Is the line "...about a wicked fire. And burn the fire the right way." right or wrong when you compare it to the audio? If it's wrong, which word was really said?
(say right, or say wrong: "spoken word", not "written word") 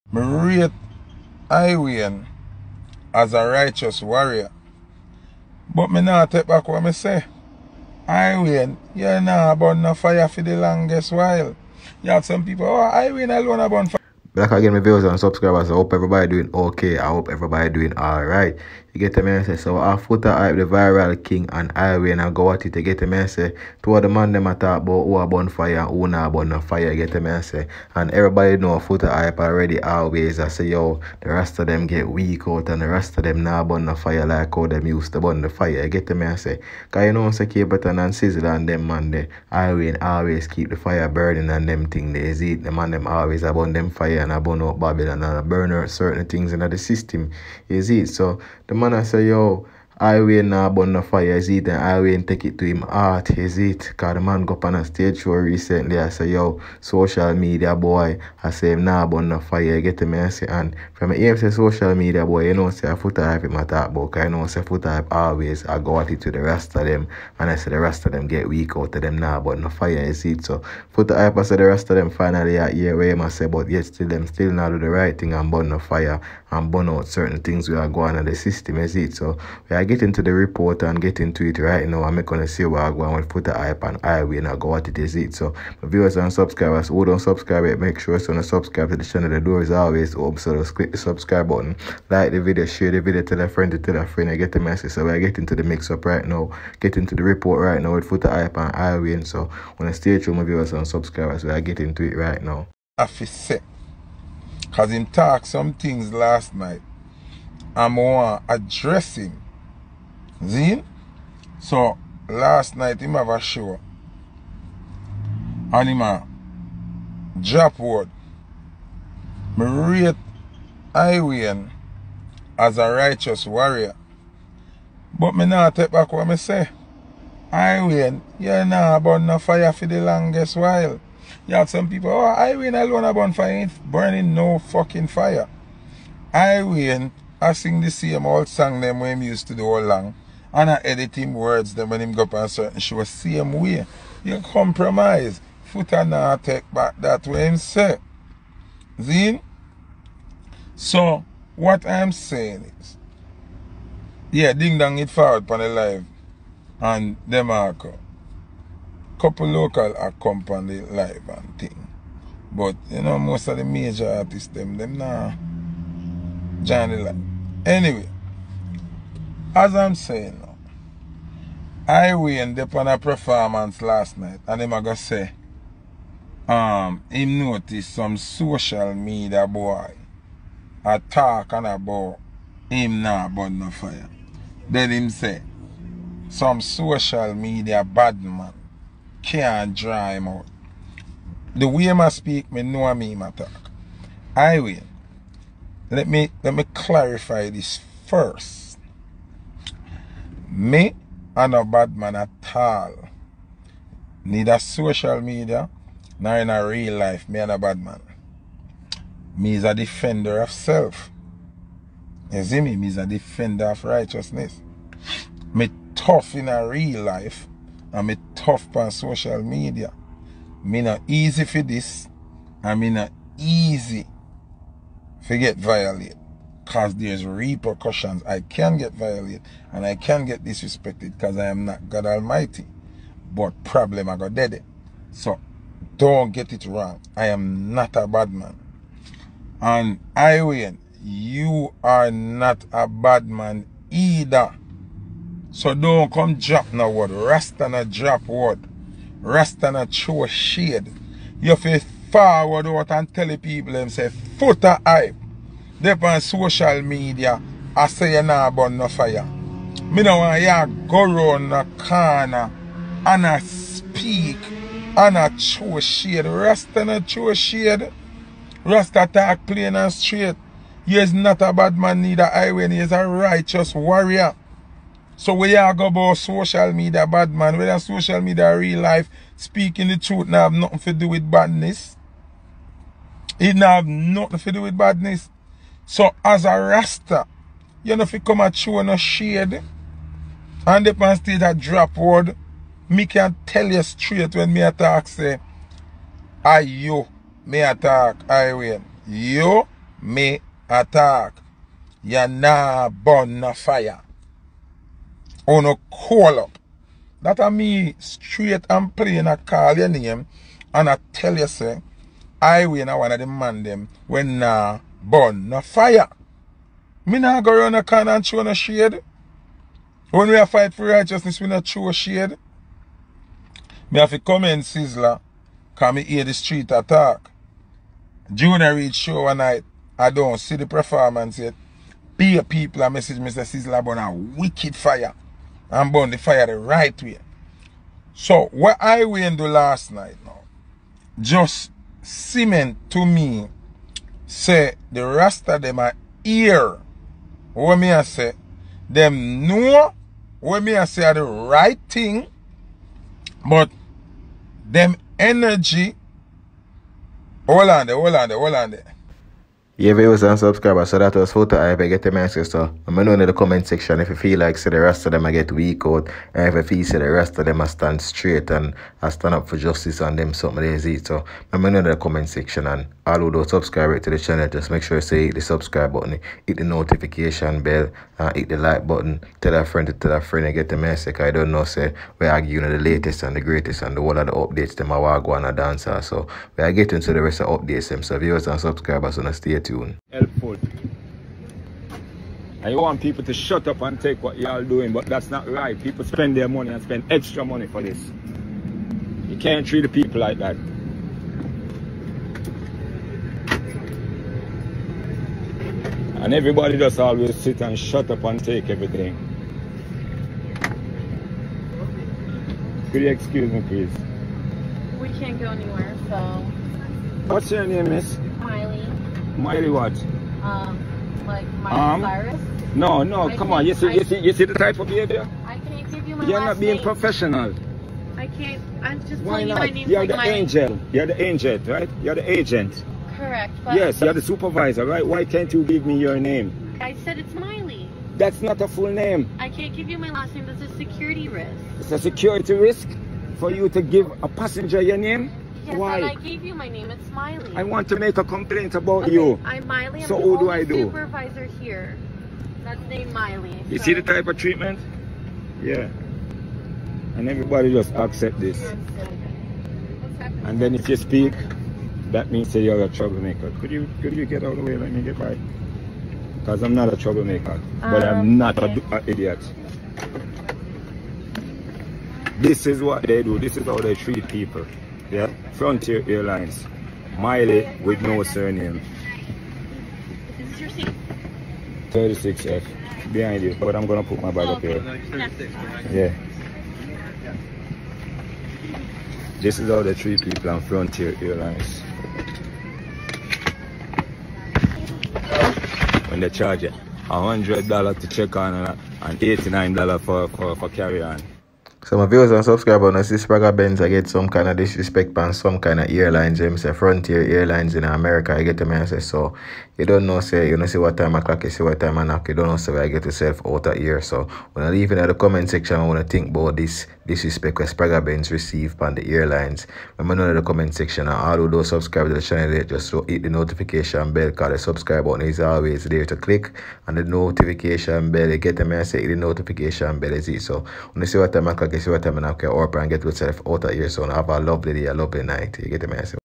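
right.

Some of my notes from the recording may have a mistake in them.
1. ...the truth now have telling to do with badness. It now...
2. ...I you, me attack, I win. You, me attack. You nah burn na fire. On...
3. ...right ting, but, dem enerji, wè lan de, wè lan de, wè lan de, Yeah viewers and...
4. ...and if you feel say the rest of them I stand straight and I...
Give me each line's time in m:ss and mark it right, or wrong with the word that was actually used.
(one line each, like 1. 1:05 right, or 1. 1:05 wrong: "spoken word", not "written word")
1. 4:39 wrong: "nothing", not "telling"
2. 4:56 right
3. 5:51 right
4. 6:06 right.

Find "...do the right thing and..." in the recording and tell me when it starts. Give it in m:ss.
1:14.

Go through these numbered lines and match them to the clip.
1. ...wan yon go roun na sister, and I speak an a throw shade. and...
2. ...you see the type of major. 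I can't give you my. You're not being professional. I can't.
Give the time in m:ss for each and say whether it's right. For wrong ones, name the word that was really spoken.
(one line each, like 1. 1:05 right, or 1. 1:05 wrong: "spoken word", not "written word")
1. 4:20 wrong: "corner", not "sister"
2. 7:04 wrong: "behavior", not "major".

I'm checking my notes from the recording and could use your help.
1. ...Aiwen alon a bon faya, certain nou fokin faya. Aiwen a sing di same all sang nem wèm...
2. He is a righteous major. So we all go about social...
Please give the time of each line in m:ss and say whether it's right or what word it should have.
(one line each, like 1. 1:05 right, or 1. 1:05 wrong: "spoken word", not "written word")
1. 2:12 wrong: "burnin", not "certain"
2. 4:32 wrong: "warrior", not "major".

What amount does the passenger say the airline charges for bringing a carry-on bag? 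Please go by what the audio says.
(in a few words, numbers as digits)
$89.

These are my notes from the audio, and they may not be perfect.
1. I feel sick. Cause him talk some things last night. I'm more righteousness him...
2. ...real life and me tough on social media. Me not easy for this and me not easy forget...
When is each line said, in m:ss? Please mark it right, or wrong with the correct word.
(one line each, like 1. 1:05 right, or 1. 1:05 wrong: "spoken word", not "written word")
1. 1:42 wrong: "address", not "righteousness"
2. 3:36 right.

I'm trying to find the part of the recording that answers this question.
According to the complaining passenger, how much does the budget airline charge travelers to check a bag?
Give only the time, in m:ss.
8:17.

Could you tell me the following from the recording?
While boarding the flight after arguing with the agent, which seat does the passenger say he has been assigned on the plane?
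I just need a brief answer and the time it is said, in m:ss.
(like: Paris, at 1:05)
36F, at 8:01.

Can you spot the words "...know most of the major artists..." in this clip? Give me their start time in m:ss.
2:43.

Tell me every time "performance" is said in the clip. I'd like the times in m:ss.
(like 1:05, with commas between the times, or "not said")
2:52, 5:30.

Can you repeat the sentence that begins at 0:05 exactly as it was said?
Bout mi nan tep akwa mi se, Iwen, yo nan abon nan faya fi di langes wail.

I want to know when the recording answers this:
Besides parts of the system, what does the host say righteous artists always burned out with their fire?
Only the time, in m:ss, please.
0:44.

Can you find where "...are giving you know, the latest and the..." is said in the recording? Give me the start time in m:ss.
6:22.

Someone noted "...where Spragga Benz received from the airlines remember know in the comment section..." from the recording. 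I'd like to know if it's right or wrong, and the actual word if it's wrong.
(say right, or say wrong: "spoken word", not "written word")
right.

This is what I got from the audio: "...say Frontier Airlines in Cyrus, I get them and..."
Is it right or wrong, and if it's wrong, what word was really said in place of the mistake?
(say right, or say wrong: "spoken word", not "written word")
wrong: "America", not "Cyrus".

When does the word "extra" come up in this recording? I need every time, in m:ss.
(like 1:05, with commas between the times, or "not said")
6:37.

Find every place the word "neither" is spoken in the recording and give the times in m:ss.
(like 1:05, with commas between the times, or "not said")
3:24, 4:32.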